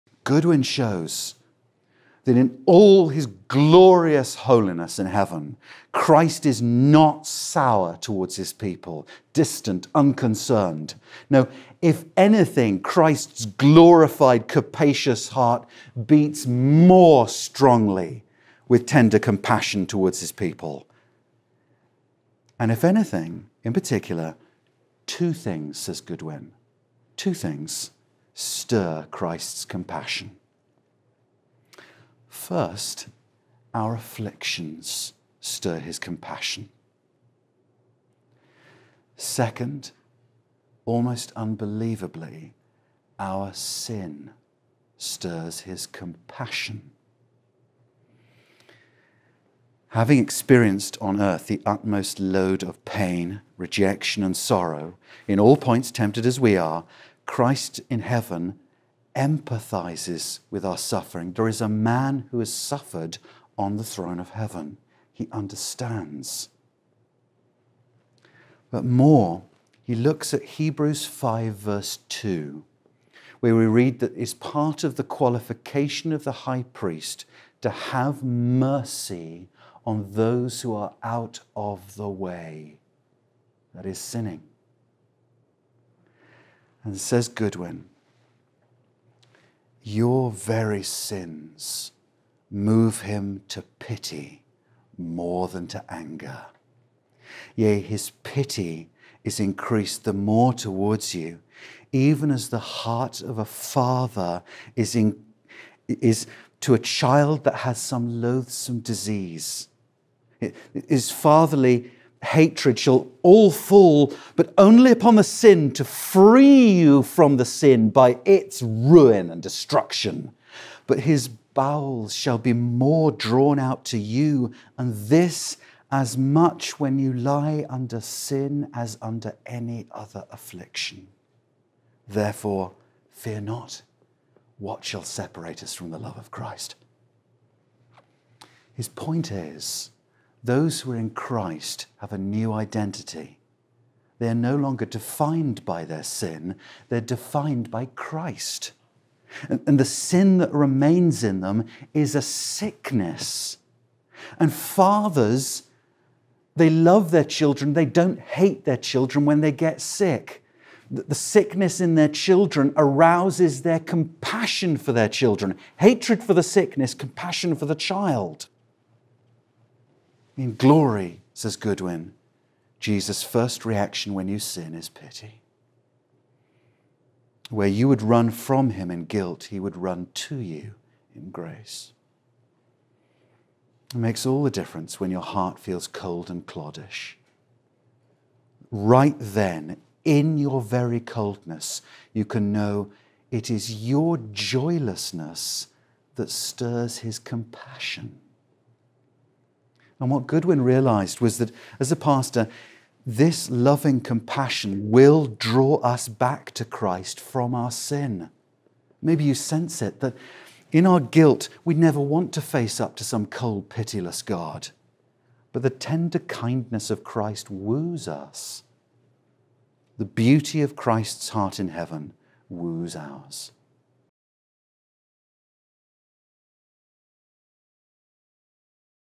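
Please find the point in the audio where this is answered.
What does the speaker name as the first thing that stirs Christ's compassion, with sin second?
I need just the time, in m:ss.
0:33.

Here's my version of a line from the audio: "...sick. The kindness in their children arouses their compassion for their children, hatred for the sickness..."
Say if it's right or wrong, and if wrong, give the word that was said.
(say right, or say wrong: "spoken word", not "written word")
wrong: "sickness", not "kindness".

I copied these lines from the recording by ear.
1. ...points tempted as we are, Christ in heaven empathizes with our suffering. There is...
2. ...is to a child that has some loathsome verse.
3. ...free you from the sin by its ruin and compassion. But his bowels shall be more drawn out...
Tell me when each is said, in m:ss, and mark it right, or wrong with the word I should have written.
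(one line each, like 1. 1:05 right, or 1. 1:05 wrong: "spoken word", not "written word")
1. 0:55 right
2. 1:45 wrong: "disease", not "verse"
3. 1:55 wrong: "destruction", not "compassion".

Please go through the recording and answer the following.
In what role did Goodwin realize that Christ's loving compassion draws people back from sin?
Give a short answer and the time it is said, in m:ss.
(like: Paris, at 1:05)
Pastor, at 3:21.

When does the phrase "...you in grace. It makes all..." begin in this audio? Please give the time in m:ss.
3:00.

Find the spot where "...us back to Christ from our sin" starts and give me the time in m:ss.
3:25.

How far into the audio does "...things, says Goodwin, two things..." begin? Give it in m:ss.
0:25.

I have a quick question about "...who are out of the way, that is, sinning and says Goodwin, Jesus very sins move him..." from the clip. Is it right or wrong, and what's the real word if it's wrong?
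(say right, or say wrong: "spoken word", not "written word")
wrong: "Your", not "Jesus".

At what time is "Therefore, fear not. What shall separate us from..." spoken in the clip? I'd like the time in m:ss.
2:12.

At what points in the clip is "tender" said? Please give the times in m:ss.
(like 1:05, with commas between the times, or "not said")
0:18, 3:35.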